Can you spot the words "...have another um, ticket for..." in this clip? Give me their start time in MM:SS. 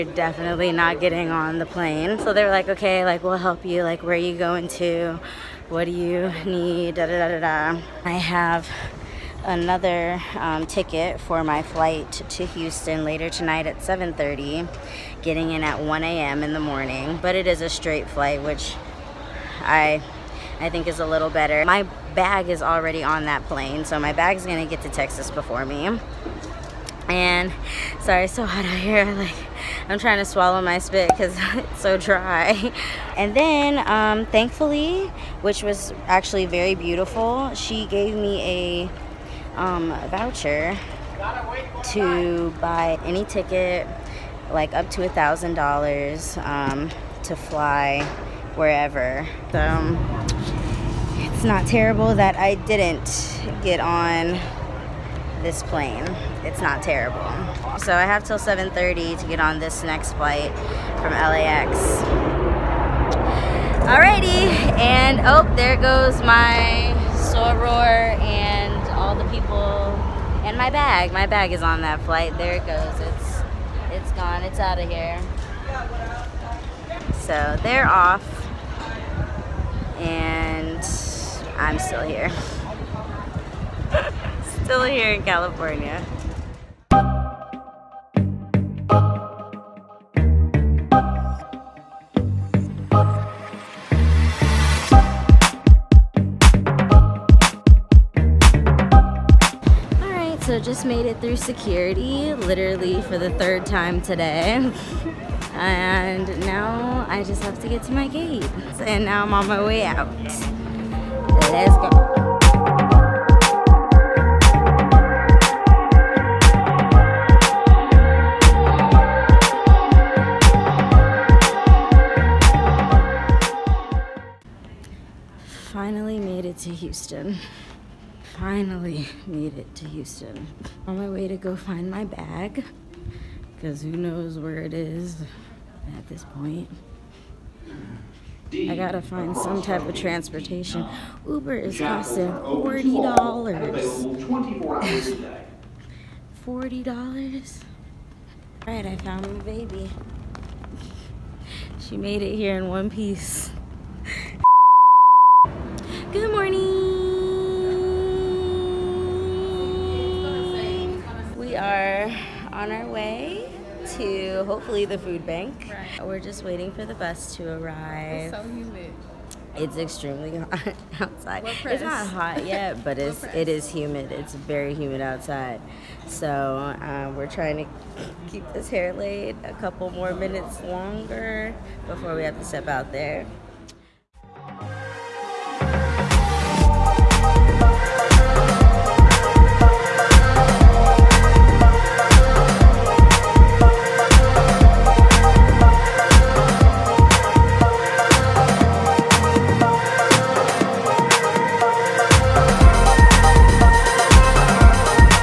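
00:08.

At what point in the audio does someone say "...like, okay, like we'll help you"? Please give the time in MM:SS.
00:02.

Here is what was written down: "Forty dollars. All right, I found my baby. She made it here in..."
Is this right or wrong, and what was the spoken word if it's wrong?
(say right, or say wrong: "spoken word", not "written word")
right.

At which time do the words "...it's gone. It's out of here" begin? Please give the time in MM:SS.
01:13.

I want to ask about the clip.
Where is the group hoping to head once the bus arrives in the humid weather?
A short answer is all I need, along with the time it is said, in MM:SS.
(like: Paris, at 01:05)
The food bank, at 02:44.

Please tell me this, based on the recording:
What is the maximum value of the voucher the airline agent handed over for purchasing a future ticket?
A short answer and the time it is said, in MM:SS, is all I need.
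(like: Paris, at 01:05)
$1,000, at 00:45.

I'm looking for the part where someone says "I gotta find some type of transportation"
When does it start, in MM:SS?
02:18.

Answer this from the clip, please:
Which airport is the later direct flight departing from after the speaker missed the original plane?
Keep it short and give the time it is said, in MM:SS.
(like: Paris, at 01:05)
LAX, at 01:01.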